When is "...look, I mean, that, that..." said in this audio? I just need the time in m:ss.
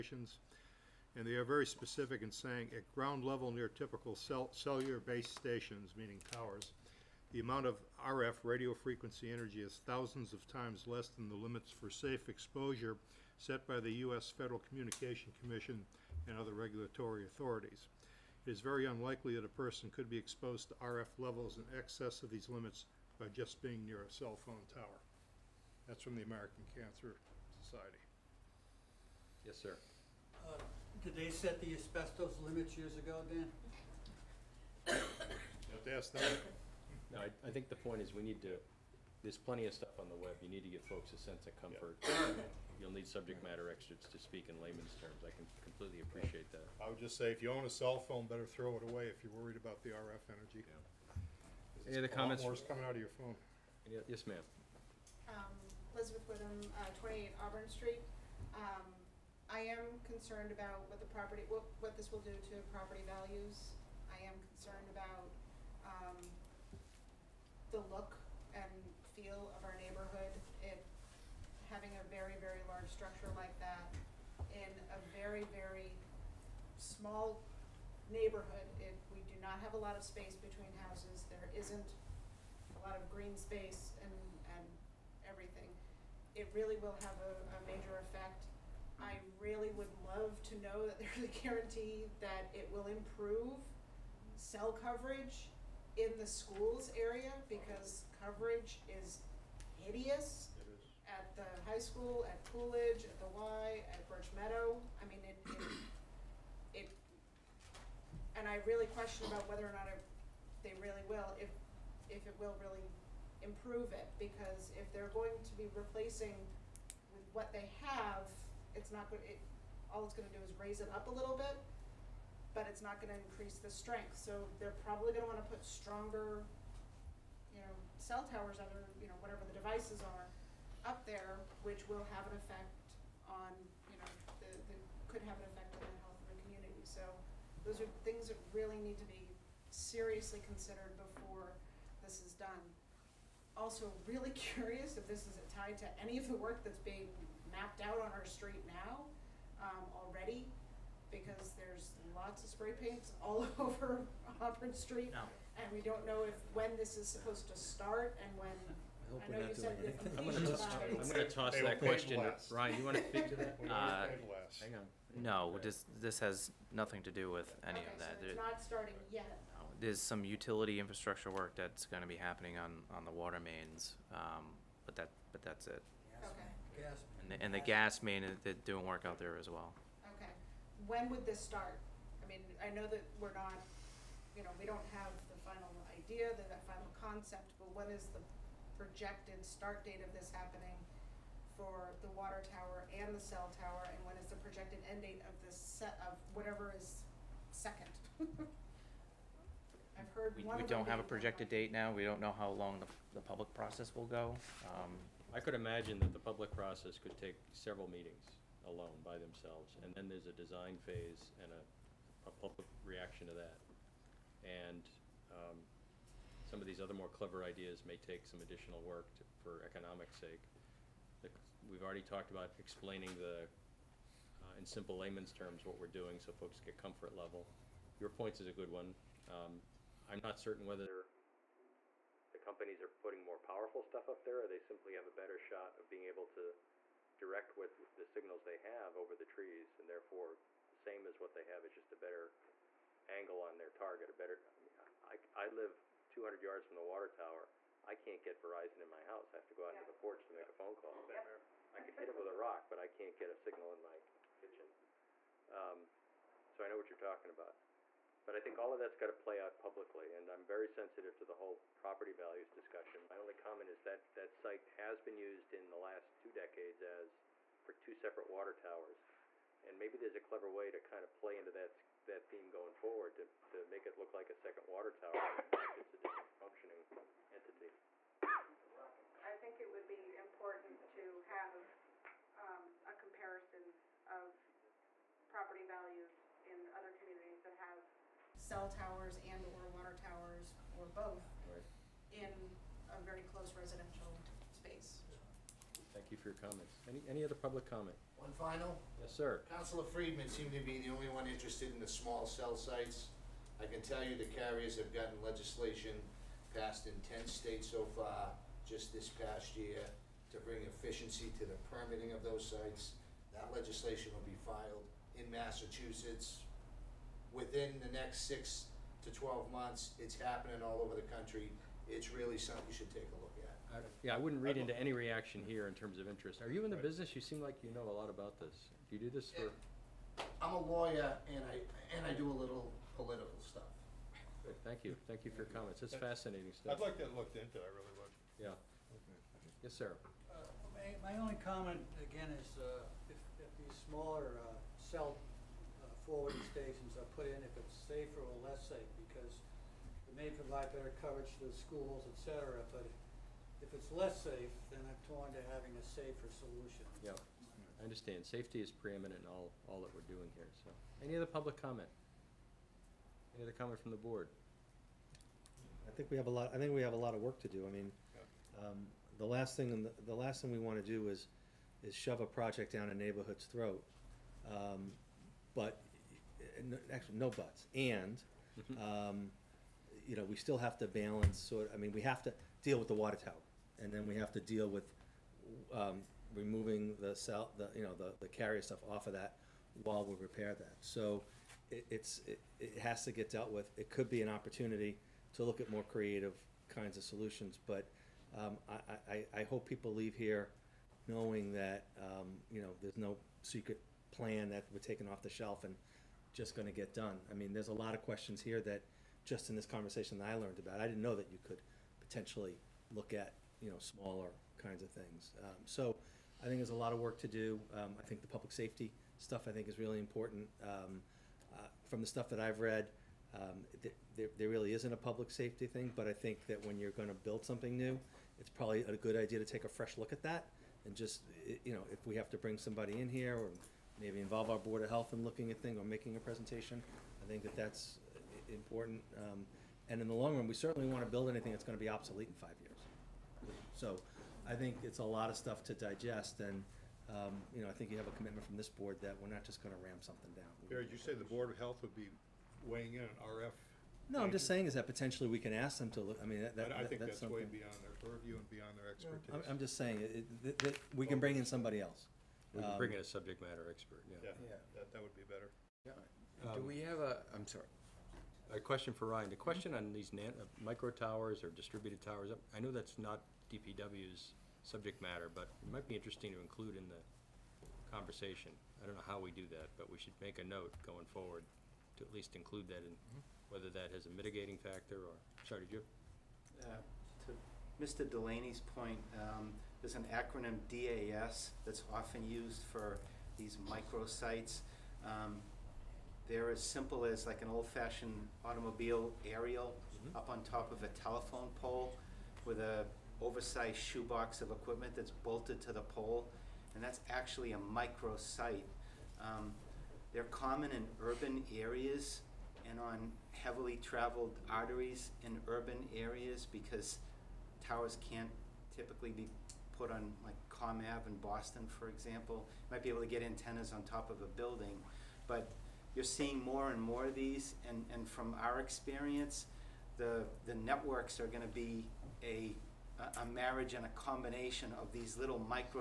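7:36.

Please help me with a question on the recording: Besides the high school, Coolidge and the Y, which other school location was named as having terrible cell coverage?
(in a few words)
Birch Meadow.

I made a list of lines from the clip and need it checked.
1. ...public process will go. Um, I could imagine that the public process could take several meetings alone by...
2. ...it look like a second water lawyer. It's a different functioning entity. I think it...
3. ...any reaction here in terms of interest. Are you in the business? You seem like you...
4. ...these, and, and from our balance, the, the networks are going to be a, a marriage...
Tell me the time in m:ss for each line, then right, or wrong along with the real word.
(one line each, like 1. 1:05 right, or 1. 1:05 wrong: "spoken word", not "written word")
1. 3:23 right
2. 4:33 wrong: "tower", not "lawyer"
3. 5:24 right
4. 8:47 wrong: "experience", not "balance".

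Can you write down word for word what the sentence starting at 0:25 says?
That's from the American Cancer Society.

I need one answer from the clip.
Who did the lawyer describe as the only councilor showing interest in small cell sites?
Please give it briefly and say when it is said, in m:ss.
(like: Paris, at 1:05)
Councilor Friedmann, at 4:59.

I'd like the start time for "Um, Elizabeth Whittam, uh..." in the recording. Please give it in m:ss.
0:55.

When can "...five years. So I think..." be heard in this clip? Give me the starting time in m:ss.
7:22.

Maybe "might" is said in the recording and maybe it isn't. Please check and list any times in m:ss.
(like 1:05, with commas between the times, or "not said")
7:55, 8:42.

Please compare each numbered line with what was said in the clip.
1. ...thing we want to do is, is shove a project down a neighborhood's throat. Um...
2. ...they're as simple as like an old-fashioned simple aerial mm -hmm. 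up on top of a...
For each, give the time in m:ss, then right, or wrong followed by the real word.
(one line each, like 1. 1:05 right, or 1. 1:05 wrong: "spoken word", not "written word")
1. 6:10 right
2. 8:16 wrong: "automobile", not "simple".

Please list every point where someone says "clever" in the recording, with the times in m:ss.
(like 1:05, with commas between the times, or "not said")
3:37, 4:30.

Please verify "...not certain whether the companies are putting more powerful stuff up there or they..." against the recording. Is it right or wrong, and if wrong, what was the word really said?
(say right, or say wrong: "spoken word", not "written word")
right.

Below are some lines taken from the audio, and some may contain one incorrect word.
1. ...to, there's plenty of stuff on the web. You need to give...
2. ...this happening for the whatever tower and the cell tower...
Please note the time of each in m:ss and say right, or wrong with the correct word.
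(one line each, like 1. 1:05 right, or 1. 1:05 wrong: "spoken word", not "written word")
1. 0:38 right
2. 3:10 wrong: "water", not "whatever".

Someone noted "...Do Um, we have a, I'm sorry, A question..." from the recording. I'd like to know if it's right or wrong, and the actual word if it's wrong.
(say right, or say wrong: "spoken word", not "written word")
right.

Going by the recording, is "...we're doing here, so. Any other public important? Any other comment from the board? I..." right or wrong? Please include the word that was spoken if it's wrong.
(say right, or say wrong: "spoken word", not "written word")
wrong: "comment", not "important".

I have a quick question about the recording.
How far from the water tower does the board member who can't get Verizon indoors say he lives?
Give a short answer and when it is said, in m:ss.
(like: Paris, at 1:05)
200 yards, at 4:06.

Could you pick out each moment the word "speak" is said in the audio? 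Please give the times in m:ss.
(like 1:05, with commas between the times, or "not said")
0:44, 2:43.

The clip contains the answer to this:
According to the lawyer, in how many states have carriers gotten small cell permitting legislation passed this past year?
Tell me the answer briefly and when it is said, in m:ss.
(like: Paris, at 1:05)
10, at 5:07.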